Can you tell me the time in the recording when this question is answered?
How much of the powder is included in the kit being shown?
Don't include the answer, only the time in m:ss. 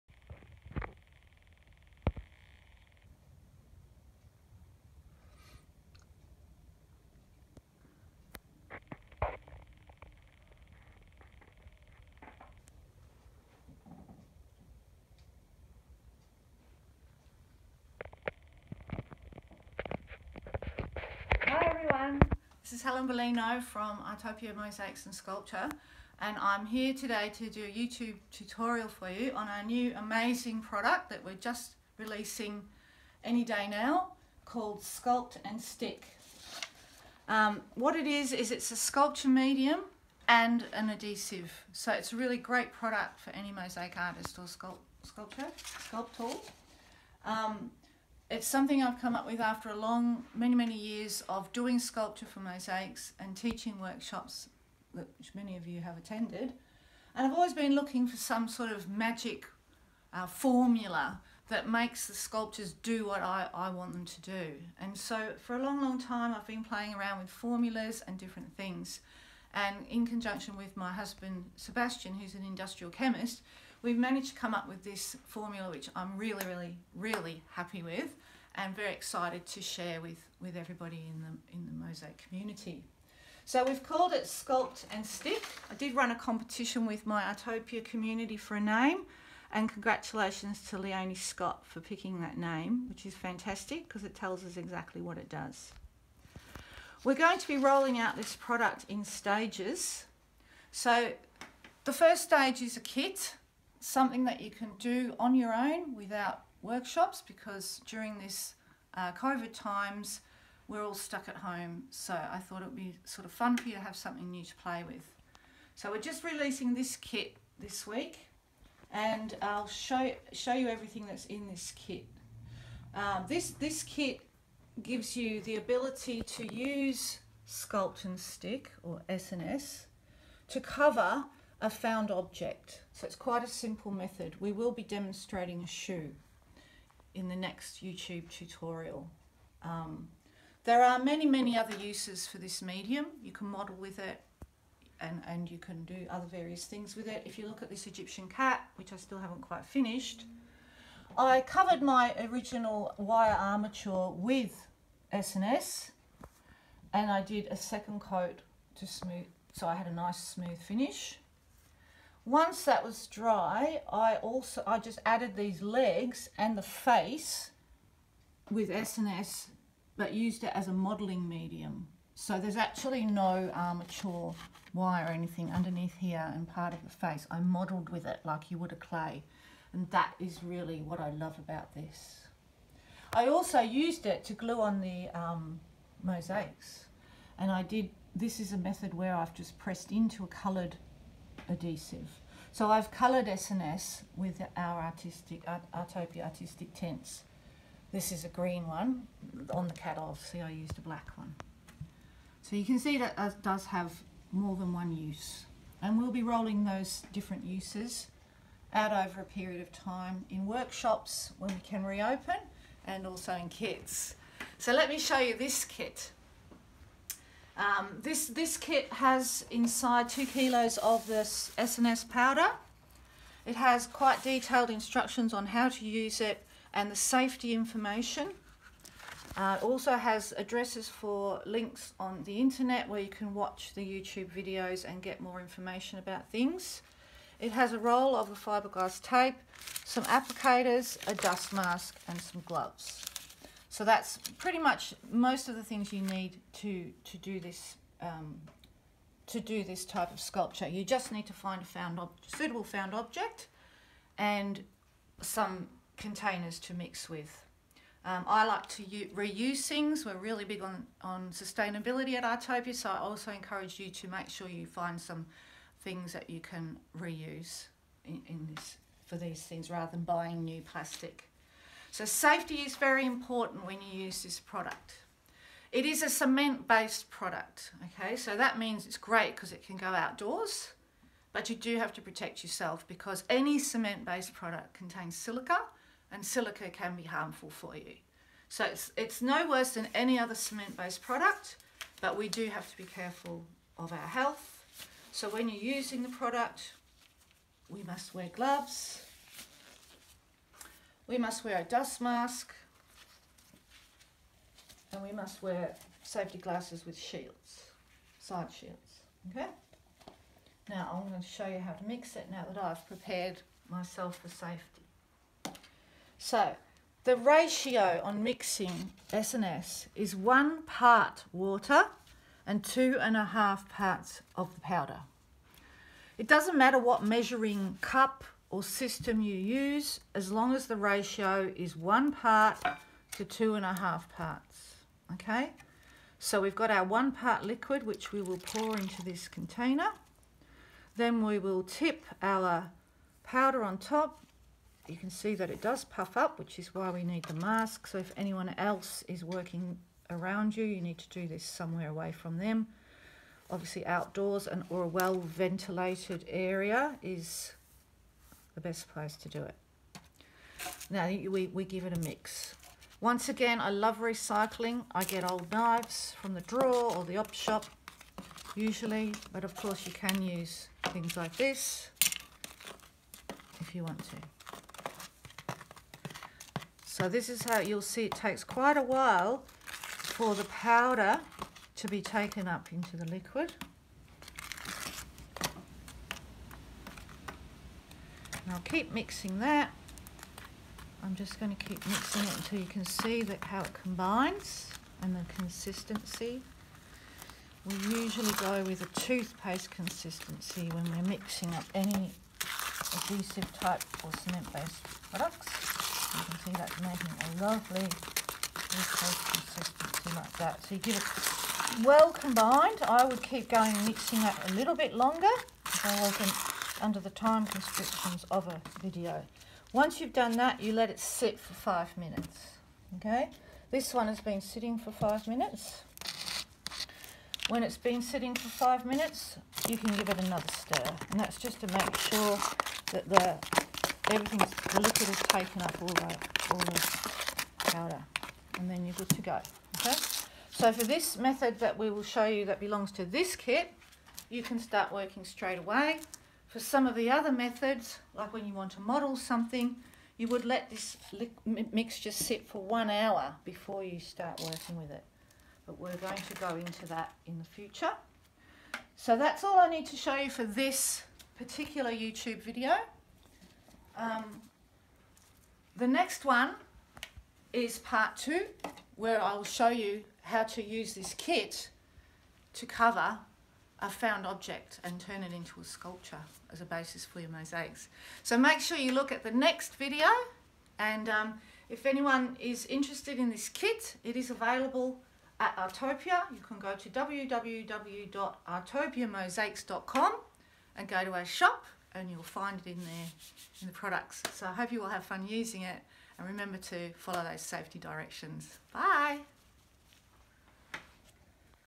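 3:40.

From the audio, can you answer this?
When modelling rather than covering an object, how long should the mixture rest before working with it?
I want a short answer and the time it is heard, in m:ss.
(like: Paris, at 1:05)
1 hour, at 7:32.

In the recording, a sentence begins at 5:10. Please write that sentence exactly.
Now I'm going to show you how to mix it now that I've prepared myself for safety.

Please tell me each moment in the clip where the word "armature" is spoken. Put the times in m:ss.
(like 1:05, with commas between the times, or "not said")
2:33, 2:53.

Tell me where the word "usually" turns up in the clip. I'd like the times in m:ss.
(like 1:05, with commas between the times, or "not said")
6:08, 6:37.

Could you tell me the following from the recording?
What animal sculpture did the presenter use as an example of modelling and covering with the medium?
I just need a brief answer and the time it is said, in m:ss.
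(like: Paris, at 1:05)
Egyptian cat, at 2:27.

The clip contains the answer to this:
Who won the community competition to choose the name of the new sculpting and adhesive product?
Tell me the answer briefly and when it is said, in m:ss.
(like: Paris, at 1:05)
Leonie Scott, at 1:30.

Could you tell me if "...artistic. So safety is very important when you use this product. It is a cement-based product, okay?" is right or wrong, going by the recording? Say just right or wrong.
wrong.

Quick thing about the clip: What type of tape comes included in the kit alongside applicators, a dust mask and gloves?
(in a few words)
Fiberglass tape.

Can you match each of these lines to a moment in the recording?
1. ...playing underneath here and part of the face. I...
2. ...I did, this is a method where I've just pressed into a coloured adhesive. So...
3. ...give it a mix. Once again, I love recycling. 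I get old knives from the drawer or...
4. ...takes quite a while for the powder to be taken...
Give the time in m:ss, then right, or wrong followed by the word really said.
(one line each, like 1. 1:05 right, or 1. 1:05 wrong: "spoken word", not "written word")
1. 2:55 wrong: "anything", not "playing"
2. 3:07 right
3. 6:01 right
4. 6:18 right.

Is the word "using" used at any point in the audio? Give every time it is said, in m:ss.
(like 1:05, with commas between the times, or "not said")
4:55, 8:15.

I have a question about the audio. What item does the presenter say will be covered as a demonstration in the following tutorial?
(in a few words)
A shoe.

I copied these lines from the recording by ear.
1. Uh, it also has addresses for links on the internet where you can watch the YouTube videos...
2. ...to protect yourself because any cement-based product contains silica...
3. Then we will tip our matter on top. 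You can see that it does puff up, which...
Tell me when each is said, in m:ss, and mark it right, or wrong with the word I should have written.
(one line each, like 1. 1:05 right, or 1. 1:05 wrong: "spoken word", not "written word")
1. 3:49 right
2. 4:41 right
3. 5:40 wrong: "powder", not "matter".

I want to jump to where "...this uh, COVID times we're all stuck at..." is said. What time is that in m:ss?
1:48.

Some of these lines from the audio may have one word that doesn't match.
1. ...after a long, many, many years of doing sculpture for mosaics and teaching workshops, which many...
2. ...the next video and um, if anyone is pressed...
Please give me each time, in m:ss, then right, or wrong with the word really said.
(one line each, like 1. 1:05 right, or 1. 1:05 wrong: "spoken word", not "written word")
1. 0:49 right
2. 7:59 wrong: "interested", not "pressed".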